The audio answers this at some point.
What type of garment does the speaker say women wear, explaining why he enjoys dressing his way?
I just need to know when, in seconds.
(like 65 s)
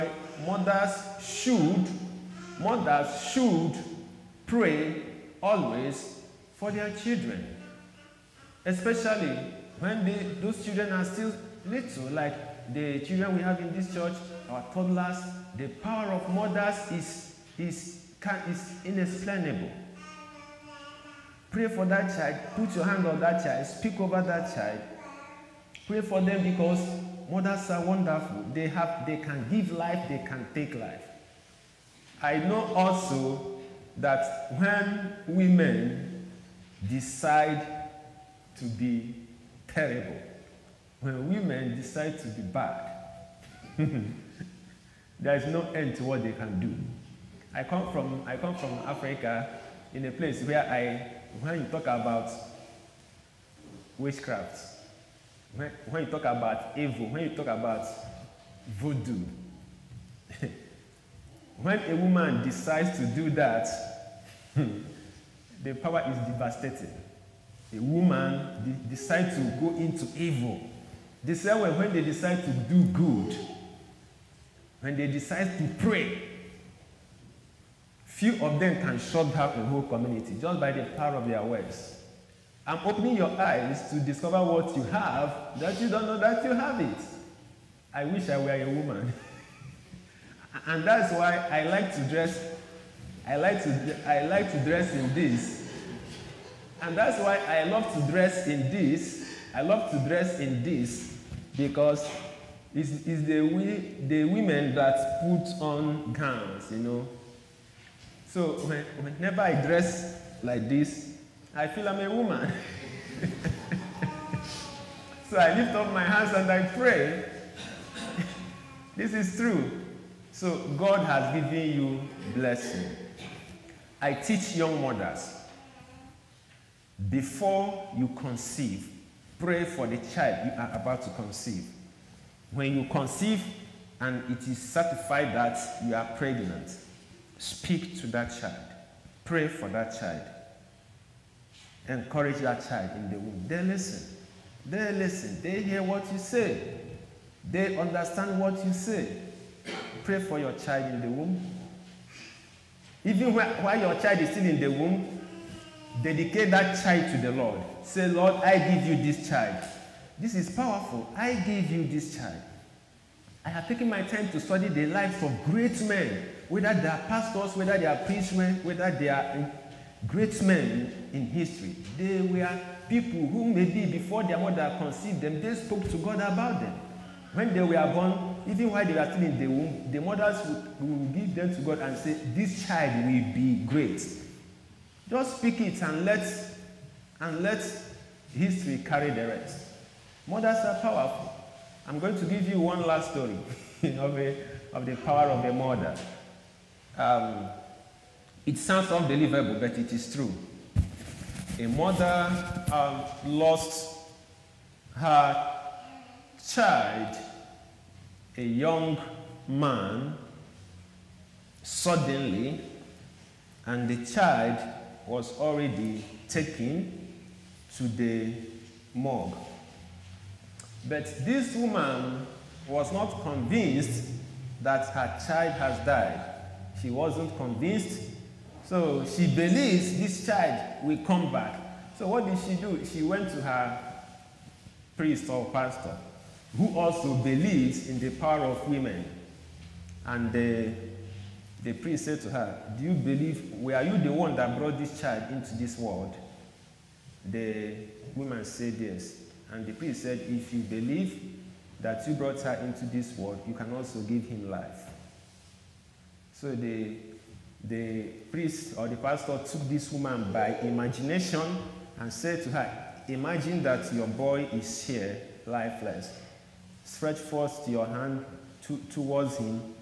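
106 s.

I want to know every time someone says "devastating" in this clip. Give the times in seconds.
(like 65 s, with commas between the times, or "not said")
66 s.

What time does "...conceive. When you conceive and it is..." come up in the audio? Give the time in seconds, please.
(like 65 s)
131 s.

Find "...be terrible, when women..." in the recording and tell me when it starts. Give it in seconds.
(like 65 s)
38 s.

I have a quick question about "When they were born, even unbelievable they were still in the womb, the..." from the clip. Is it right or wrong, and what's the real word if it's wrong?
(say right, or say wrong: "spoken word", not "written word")
wrong: "while", not "unbelievable".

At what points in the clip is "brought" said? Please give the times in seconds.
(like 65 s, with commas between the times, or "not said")
244 s, 252 s.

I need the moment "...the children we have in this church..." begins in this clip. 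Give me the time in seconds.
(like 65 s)
12 s.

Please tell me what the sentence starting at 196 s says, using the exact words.
Um, it sounds unbelievable, but it is true.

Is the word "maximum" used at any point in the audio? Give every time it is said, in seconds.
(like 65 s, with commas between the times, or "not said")
not said.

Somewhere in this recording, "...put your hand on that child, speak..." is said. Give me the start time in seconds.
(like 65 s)
22 s.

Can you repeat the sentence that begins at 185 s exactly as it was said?
Just speak it and let and let history carry the rest.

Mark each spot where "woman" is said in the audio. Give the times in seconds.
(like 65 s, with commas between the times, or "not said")
61 s, 67 s, 88 s, 112 s, 221 s, 248 s, 259 s.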